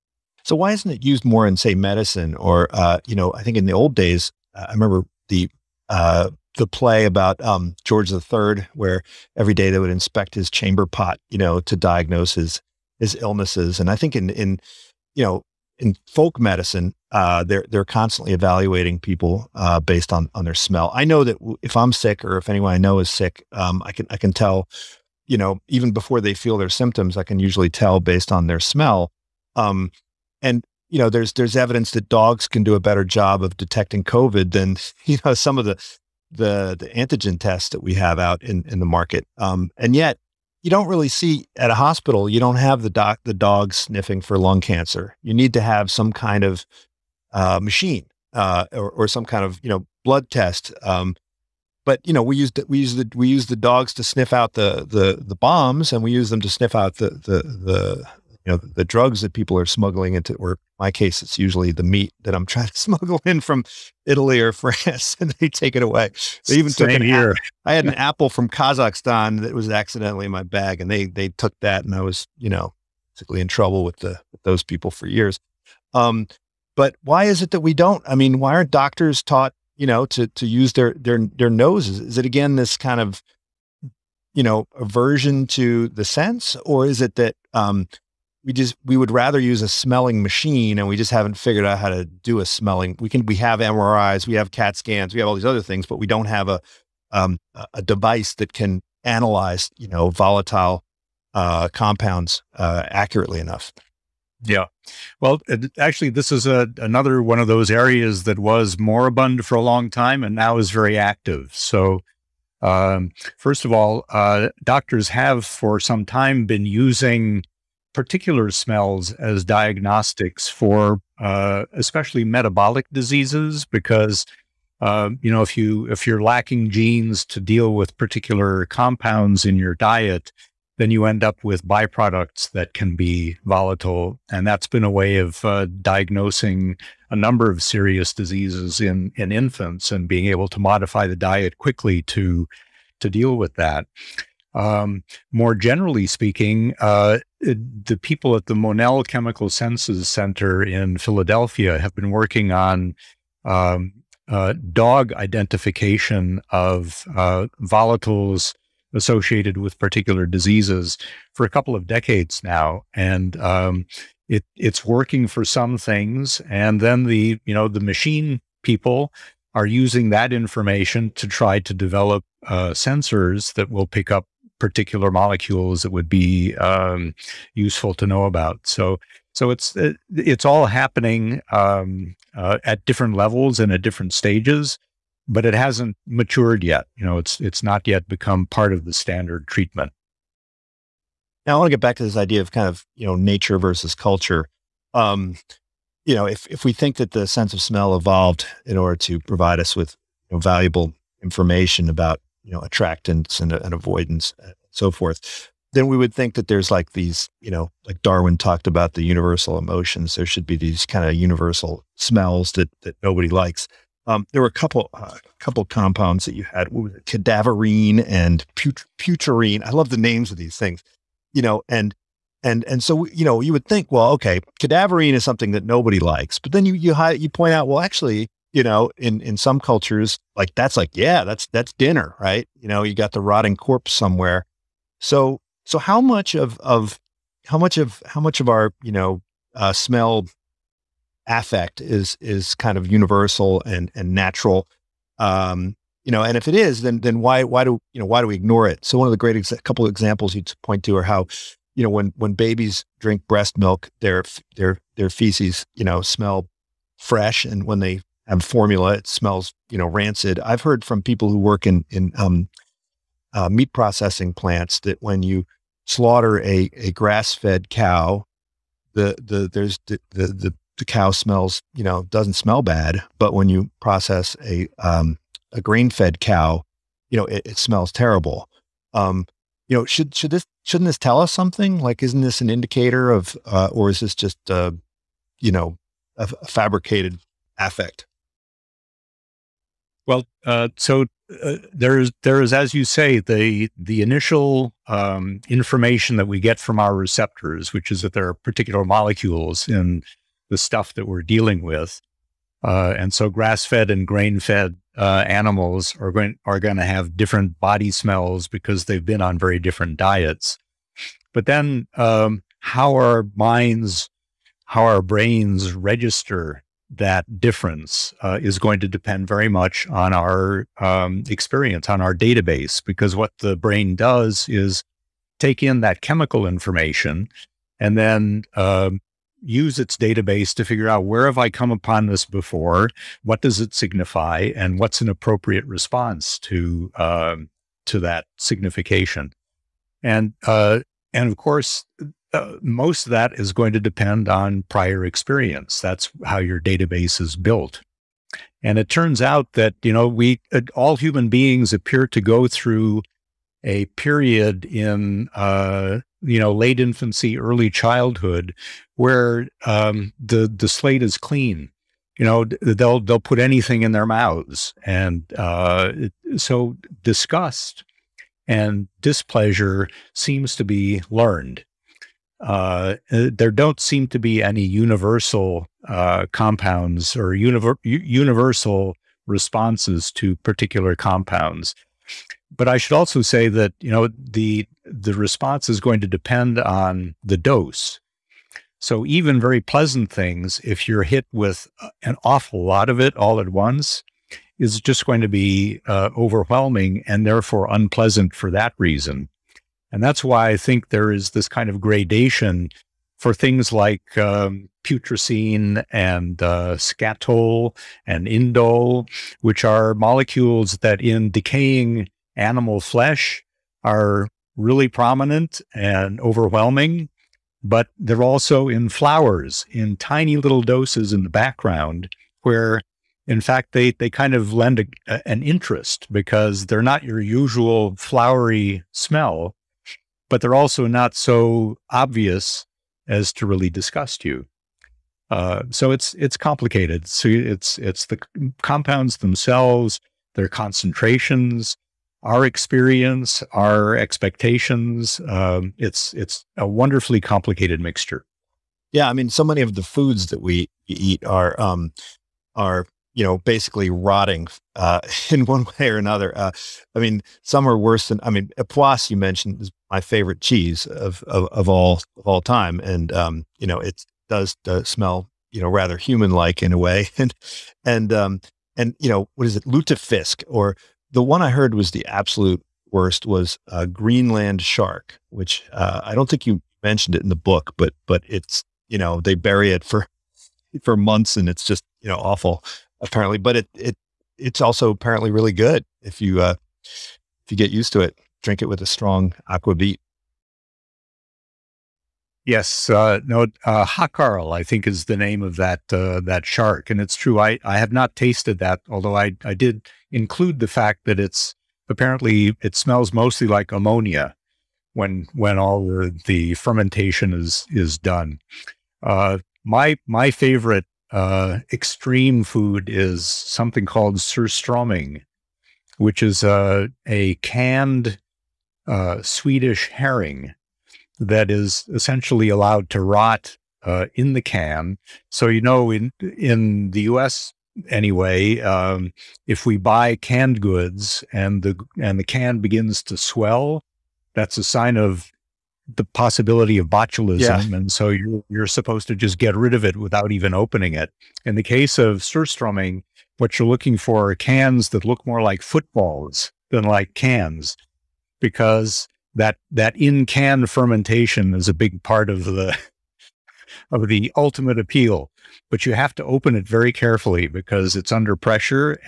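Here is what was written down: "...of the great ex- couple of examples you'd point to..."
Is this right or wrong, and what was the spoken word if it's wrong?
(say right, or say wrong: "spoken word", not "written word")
right.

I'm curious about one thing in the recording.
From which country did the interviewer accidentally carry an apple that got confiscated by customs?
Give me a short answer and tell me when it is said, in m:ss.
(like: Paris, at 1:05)
Kazakhstan, at 1:08.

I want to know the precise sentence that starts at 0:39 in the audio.
Um, and yet, you don't really see at a hospital.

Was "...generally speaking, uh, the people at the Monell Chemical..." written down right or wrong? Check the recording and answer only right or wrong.
right.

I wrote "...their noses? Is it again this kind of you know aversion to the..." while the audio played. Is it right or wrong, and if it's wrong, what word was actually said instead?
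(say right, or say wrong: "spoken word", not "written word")
right.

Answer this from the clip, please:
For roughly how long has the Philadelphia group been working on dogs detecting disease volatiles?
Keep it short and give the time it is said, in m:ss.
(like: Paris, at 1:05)
a couple of decades, at 2:41.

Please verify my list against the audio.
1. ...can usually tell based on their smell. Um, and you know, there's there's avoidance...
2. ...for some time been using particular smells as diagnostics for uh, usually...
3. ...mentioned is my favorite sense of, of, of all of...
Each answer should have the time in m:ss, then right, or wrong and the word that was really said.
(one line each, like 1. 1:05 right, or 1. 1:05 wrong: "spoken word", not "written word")
1. 0:27 wrong: "evidence", not "avoidance"
2. 1:55 wrong: "especially", not "usually"
3. 7:39 wrong: "cheese", not "sense".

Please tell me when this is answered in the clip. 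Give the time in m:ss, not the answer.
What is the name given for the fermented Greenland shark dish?
8:13.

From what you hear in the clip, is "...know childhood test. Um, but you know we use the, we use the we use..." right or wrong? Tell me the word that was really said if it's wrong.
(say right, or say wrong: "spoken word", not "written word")
wrong: "blood", not "childhood".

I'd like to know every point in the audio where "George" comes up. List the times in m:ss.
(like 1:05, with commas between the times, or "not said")
0:07.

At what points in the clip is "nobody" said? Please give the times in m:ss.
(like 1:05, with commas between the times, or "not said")
3:33, 3:45.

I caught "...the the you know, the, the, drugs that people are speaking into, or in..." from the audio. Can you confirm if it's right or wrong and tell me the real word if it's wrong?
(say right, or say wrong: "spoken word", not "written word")
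wrong: "smuggling", not "speaking".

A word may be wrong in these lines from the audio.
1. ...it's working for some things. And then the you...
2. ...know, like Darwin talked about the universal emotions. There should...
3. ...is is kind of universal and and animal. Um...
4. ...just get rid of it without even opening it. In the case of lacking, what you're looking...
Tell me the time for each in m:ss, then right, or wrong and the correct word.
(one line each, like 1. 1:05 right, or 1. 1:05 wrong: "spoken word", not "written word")
1. 2:44 right
2. 3:27 right
3. 4:01 wrong: "natural", not "animal"
4. 8:59 wrong: "surströmming", not "lacking".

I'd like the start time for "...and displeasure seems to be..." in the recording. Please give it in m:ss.
6:08.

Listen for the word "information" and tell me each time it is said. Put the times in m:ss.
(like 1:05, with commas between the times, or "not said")
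2:50, 3:21, 4:55, 5:26.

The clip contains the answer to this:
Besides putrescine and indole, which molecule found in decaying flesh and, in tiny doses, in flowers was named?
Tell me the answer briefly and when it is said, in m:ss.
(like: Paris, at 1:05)
skatole, at 6:46.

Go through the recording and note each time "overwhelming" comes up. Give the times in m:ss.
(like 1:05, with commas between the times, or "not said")
6:36, 6:56.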